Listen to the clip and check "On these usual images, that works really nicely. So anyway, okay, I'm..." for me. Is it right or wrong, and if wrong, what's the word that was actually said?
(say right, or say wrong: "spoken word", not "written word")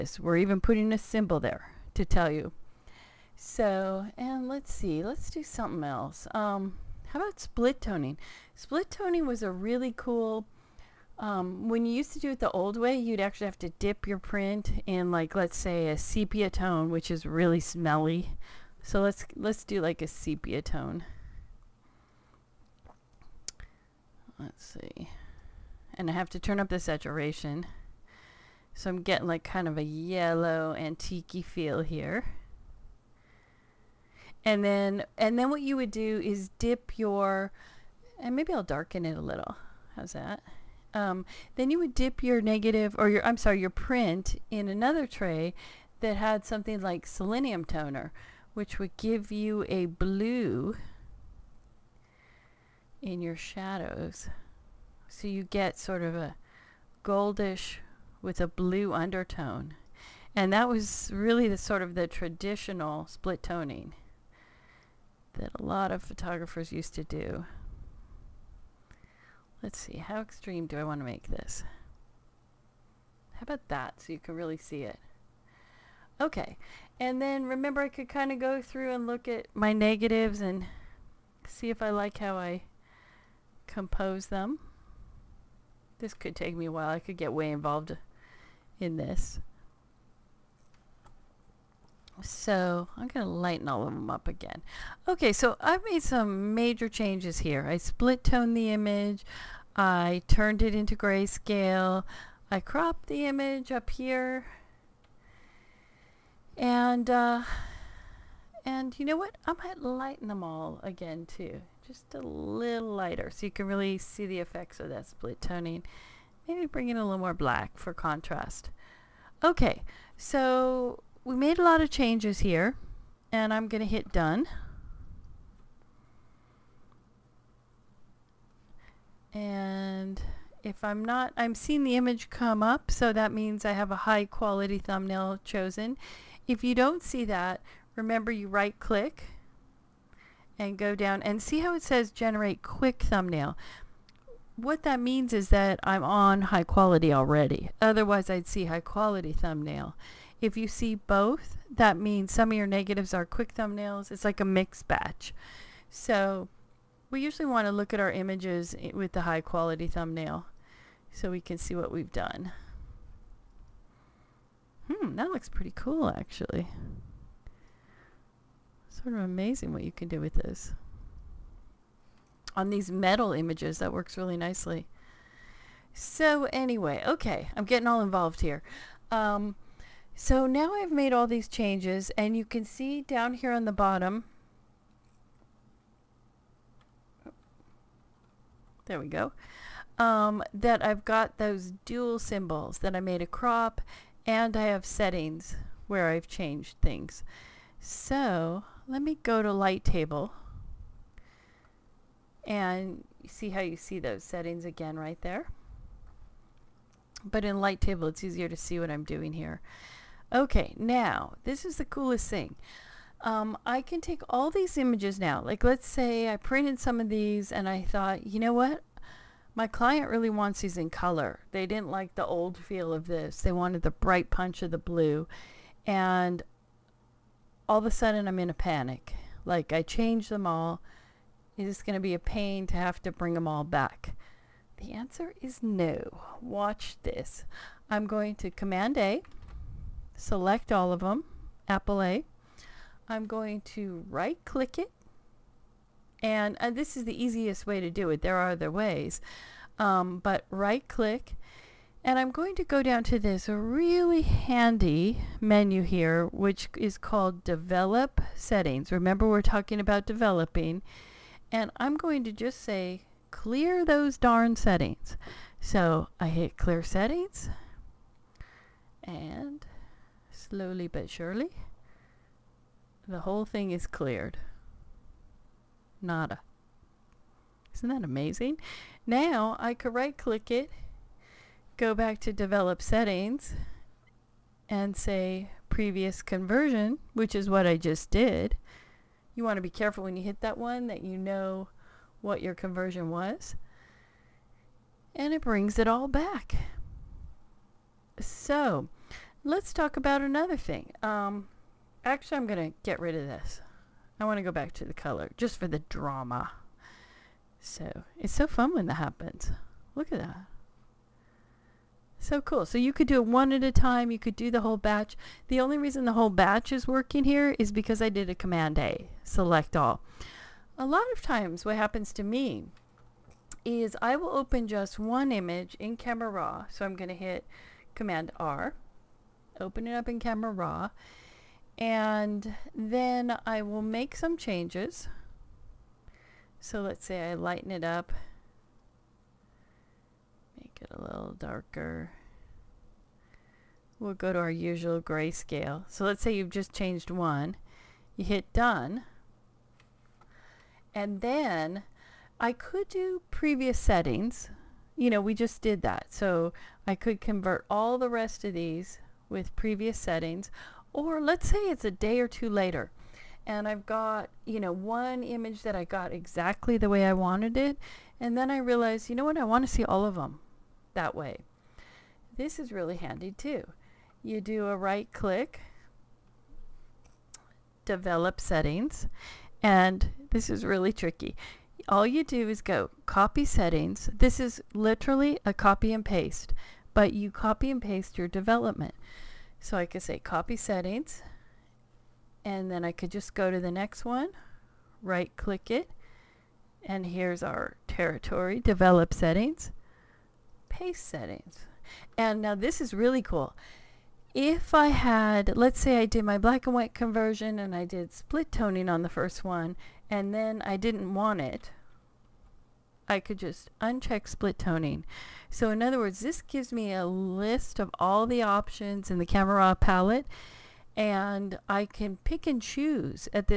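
wrong: "metal", not "usual".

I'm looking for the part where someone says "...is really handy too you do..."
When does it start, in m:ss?
6:12.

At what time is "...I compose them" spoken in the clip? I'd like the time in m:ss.
1:22.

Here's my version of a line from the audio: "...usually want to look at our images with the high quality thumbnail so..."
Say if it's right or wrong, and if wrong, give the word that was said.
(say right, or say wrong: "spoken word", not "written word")
right.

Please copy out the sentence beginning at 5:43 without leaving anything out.
We'll go to our usual grayscale.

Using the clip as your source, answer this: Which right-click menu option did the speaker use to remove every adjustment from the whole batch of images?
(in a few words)
clear settings.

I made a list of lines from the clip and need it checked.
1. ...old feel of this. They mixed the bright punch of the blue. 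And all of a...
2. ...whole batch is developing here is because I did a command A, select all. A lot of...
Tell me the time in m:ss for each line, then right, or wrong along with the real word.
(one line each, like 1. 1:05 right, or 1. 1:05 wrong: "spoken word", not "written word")
1. 3:42 wrong: "wanted", not "mixed"
2. 5:16 wrong: "working", not "developing".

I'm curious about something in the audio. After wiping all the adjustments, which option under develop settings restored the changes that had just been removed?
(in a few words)
previous conversion.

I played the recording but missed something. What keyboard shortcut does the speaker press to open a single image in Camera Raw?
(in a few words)
Command R.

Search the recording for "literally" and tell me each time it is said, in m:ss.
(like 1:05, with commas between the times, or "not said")
6:24.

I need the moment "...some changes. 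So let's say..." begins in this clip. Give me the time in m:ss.
5:34.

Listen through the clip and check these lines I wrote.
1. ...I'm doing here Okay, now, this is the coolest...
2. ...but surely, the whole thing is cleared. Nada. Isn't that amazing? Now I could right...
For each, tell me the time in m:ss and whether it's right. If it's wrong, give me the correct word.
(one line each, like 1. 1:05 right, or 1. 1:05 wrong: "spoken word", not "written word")
1. 3:28 right
2. 4:30 right.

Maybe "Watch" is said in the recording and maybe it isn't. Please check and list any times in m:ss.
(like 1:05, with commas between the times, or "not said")
3:56.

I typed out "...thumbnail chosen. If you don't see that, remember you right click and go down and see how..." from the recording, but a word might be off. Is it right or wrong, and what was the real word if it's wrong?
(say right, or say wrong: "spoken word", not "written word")
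right.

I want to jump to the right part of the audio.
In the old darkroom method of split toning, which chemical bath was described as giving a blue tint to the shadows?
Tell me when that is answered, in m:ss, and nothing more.
0:47.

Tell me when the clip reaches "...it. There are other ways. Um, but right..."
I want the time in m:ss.
4:08.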